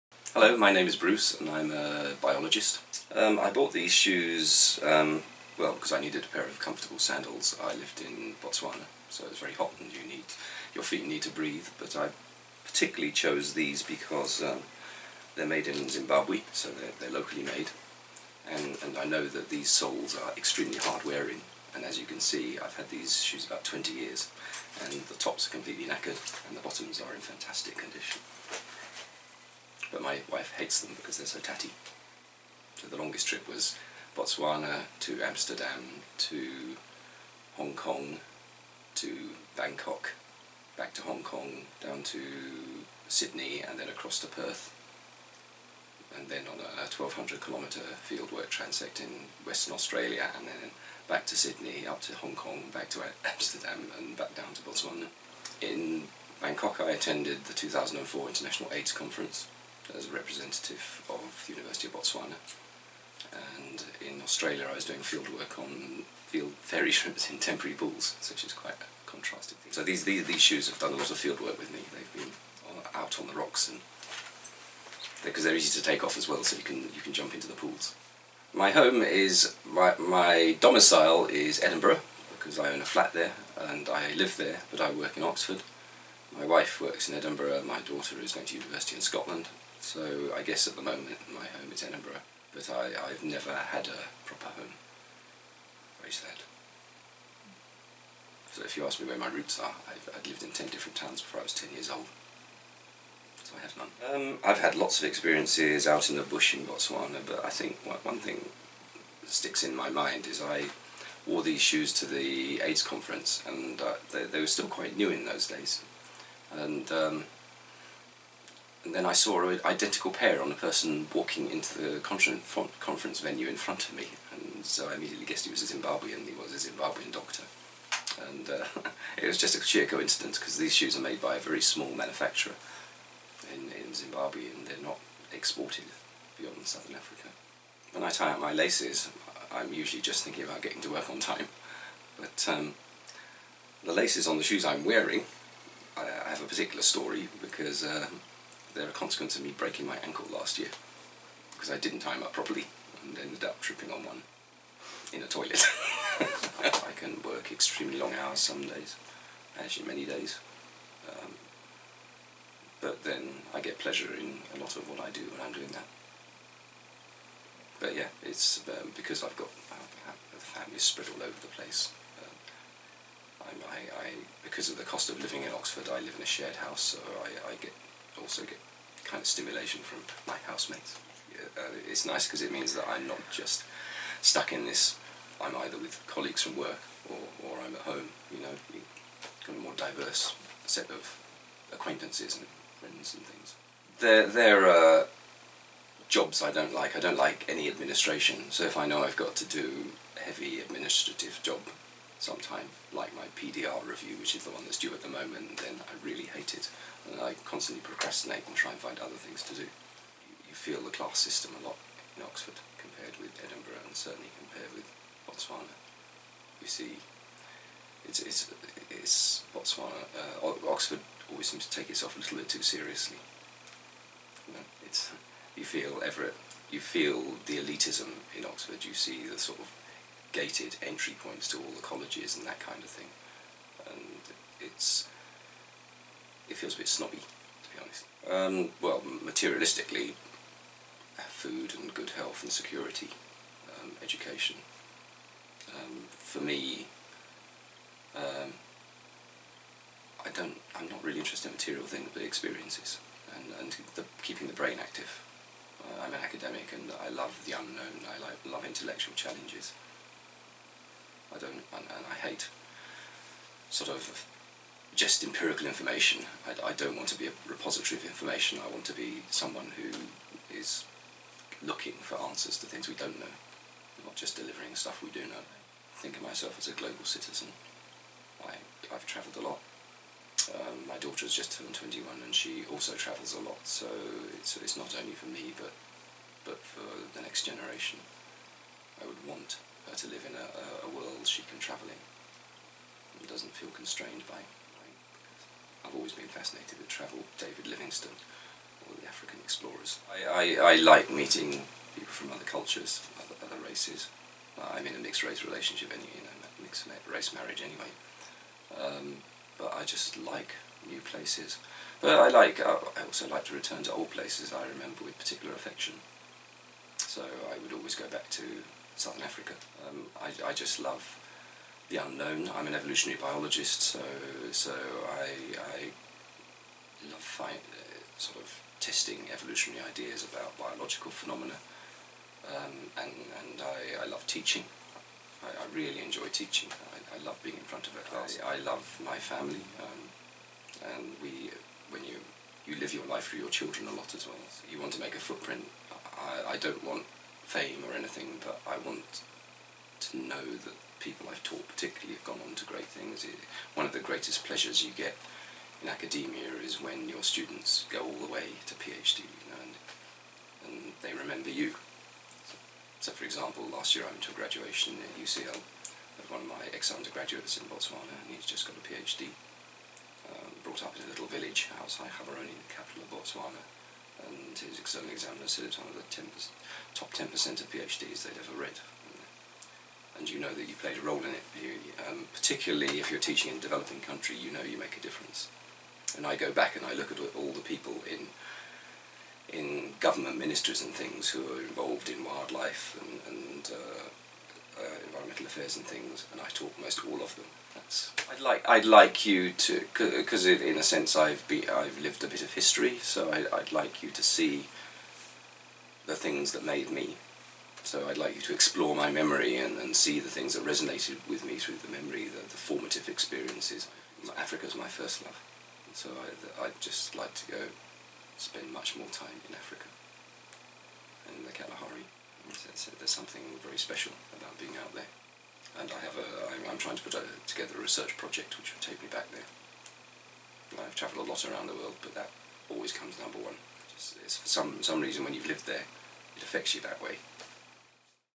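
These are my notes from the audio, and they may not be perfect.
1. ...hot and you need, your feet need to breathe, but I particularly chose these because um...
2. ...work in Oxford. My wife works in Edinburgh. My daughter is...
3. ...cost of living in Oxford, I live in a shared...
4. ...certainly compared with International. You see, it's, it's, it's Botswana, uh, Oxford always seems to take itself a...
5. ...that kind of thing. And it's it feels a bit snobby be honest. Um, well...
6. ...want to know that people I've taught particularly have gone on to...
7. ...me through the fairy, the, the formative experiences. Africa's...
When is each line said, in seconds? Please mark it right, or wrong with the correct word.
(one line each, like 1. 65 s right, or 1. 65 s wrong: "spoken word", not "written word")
1. 9 s right
2. 84 s right
3. 174 s right
4. 213 s wrong: "Botswana", not "International"
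5. 232 s right
6. 348 s right
7. 411 s wrong: "memory", not "fairy".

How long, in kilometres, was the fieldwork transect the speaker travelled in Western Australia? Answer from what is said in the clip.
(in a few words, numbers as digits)
1200.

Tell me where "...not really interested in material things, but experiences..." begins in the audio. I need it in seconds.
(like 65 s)
250 s.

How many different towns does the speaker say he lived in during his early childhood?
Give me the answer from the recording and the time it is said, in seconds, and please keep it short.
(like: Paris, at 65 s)
10, at 100 s.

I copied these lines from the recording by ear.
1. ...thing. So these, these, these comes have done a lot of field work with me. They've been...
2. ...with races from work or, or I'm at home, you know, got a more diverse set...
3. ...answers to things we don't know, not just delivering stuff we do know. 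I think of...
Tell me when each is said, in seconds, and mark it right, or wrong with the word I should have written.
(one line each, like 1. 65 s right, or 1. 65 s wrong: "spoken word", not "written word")
1. 69 s wrong: "shoes", not "comes"
2. 185 s wrong: "colleagues", not "races"
3. 272 s right.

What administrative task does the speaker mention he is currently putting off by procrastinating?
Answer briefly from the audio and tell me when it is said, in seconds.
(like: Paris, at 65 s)
PDR review, at 203 s.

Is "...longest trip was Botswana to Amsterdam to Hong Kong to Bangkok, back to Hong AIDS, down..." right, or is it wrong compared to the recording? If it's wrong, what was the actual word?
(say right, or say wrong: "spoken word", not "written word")
wrong: "Kong", not "AIDS".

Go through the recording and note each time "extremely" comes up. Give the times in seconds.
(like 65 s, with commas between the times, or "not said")
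20 s, 157 s.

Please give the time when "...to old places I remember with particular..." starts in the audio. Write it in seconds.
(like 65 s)
313 s.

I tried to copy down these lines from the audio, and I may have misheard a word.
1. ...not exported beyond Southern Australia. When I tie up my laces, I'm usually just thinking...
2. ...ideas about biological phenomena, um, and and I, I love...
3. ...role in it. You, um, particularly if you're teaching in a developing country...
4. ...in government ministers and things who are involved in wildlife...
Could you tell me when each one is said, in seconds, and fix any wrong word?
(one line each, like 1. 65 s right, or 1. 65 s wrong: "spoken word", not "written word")
1. 134 s wrong: "Africa", not "Australia"
2. 329 s right
3. 381 s right
4. 389 s right.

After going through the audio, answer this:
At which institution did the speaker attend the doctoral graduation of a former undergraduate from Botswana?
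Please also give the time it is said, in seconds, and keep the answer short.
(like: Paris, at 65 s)
UCL, at 365 s.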